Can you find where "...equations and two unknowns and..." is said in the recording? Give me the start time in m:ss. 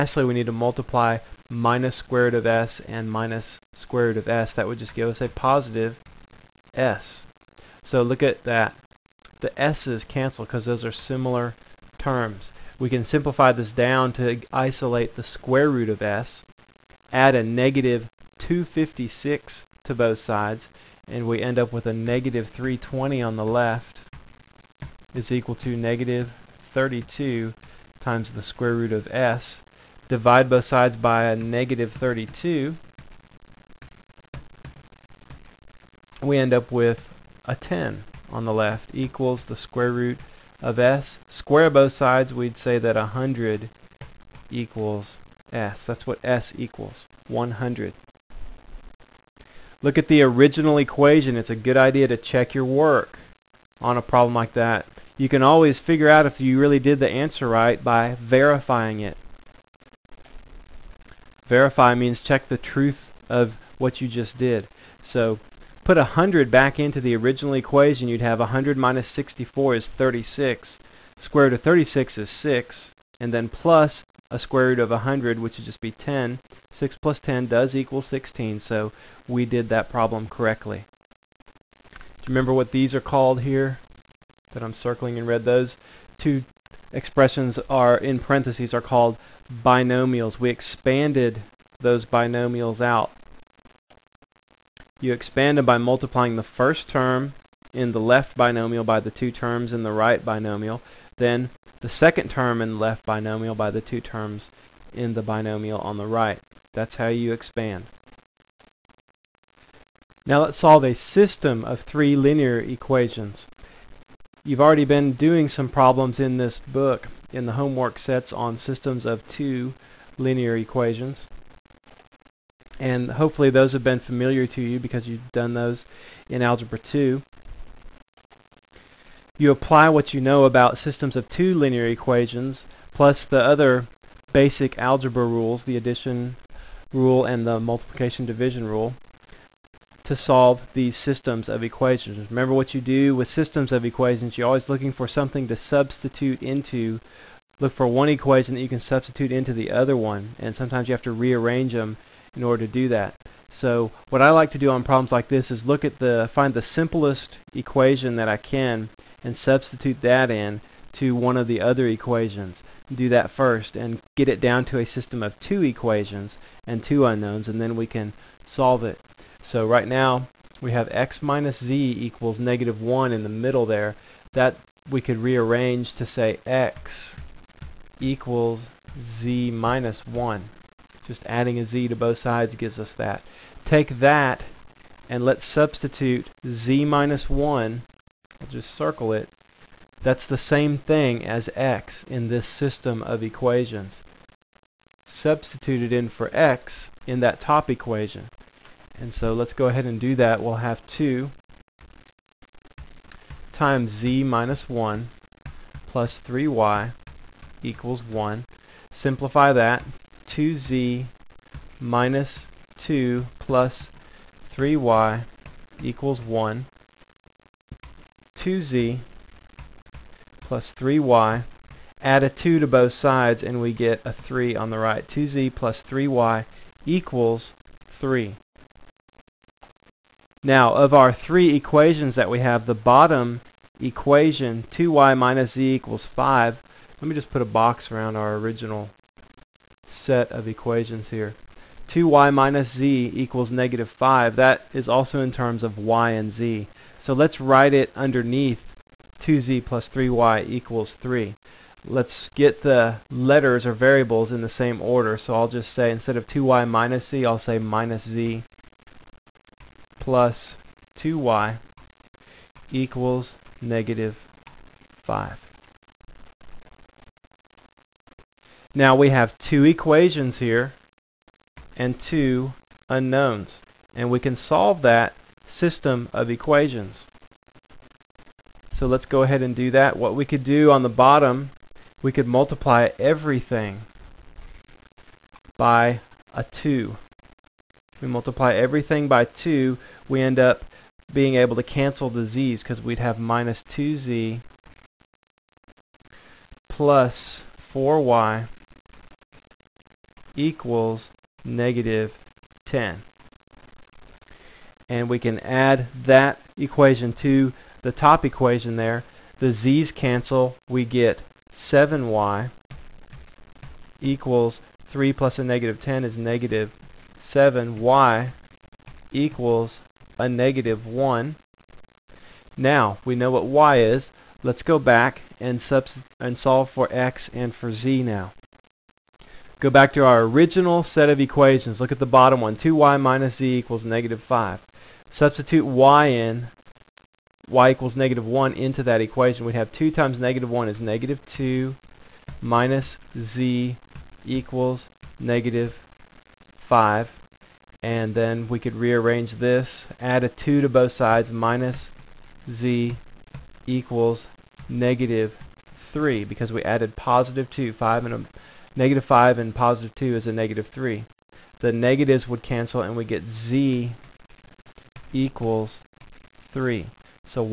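2:45.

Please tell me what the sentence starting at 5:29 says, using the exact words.
Go back to our original set of equations.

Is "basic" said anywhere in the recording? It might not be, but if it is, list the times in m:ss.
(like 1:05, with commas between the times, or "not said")
2:14.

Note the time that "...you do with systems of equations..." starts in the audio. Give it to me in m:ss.
2:22.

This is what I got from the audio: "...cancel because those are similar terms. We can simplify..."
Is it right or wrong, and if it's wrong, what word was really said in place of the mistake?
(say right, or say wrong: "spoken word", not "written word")
right.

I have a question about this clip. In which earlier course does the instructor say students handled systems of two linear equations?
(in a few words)
Algebra 2.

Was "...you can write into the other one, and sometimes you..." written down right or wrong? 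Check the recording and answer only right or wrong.
wrong.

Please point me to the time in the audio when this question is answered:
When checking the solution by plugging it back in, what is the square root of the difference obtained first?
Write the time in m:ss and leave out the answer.
1:11.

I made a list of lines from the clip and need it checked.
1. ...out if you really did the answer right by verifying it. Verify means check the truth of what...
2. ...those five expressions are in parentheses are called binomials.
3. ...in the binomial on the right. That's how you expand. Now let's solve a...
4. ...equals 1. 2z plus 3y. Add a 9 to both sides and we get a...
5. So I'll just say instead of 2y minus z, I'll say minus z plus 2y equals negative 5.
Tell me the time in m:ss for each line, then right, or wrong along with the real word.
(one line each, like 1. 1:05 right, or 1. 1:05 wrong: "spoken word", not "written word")
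1. 0:56 right
2. 1:25 wrong: "two", not "five"
3. 1:44 right
4. 3:35 wrong: "2", not "9"
5. 4:15 right.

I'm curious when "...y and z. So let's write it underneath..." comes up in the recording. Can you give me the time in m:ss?
4:05.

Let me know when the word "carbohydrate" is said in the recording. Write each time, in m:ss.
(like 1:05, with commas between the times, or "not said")
not said.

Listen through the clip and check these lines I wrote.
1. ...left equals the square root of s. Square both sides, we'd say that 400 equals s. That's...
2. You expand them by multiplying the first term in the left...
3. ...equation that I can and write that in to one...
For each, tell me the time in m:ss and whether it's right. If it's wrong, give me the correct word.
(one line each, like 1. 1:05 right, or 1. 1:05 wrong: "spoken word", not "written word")
1. 0:38 wrong: "100", not "400"
2. 1:35 right
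3. 2:37 wrong: "substitute", not "write".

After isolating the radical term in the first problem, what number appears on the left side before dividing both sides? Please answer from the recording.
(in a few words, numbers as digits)
-320.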